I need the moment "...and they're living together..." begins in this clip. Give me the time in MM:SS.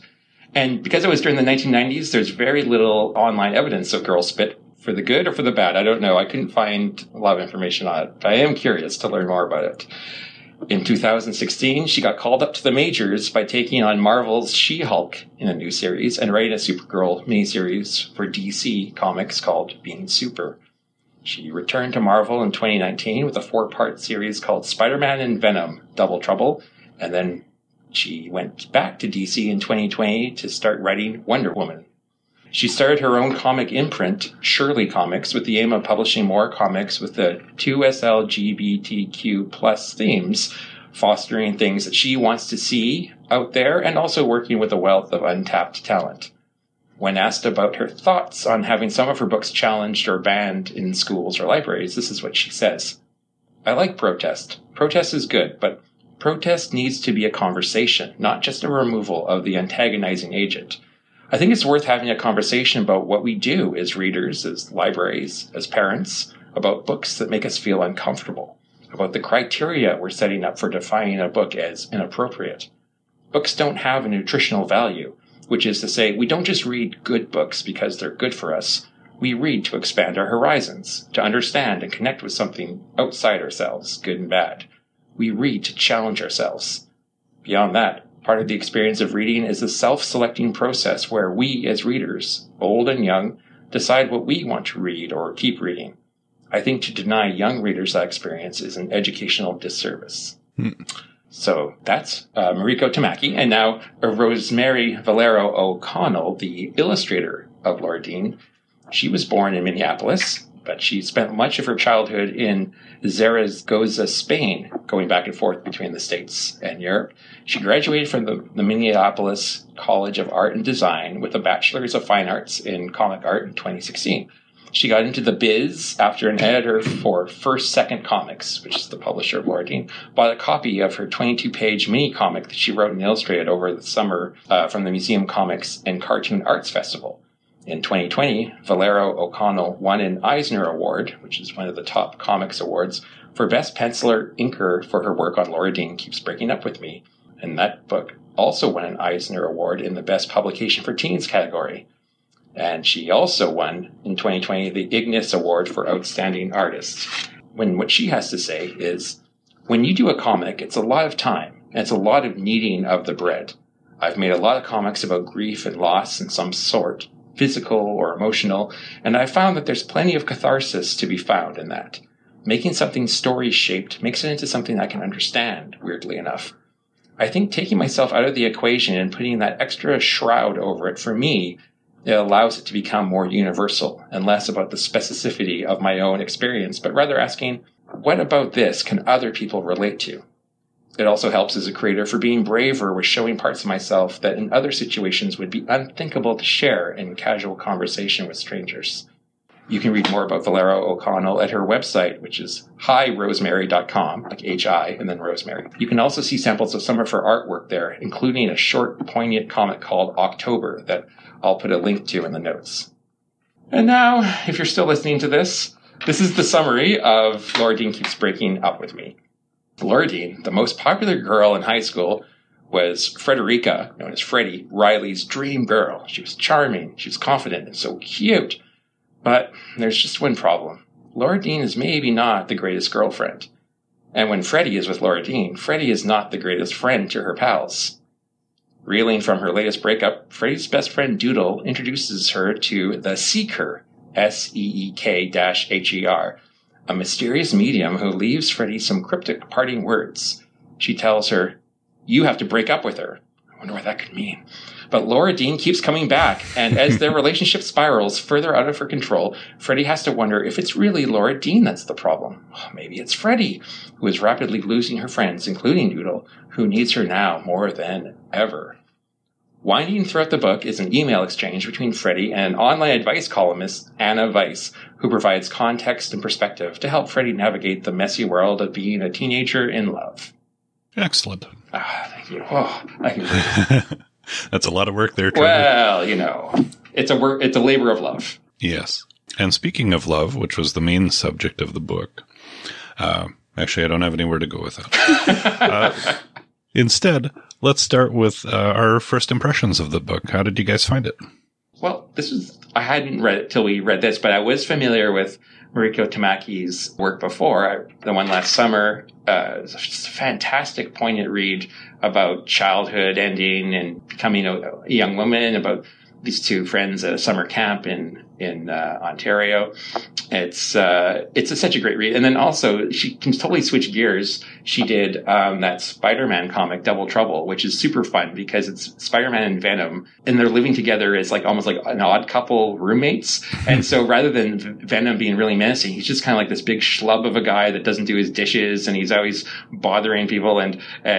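05:30.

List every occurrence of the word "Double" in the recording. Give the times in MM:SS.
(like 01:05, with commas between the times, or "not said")
00:25, 05:26.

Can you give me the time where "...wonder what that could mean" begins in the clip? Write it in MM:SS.
04:13.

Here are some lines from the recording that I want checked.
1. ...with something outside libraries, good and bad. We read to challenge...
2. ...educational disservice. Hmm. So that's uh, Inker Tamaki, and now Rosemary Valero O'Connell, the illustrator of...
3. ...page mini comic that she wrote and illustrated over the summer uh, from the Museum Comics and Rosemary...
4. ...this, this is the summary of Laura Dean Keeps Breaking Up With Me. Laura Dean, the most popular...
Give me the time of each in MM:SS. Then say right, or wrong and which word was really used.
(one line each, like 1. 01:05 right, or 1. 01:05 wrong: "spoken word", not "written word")
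1. 01:22 wrong: "ourselves", not "libraries"
2. 01:38 wrong: "Mariko", not "Inker"
3. 02:11 wrong: "Cartoon", not "Rosemary"
4. 03:35 right.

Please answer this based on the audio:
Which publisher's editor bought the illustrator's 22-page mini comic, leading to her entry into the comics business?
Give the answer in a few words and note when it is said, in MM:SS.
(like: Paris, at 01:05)
First Second Comics, at 02:07.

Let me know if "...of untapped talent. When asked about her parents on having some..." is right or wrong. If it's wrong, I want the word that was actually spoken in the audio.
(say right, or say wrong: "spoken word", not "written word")
wrong: "thoughts", not "parents".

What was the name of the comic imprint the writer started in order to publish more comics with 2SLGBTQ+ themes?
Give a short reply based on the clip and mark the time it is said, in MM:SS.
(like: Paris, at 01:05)
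Surely Comics, at 00:34.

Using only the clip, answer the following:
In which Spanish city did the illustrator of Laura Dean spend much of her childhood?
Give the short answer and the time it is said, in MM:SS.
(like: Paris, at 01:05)
Zaragoza, at 01:53.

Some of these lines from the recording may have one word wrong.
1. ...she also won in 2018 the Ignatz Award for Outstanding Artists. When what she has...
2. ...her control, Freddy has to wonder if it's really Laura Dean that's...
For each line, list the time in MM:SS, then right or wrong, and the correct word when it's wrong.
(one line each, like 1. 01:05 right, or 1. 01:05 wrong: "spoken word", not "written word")
1. 02:32 wrong: "2020", not "2018"
2. 04:18 right.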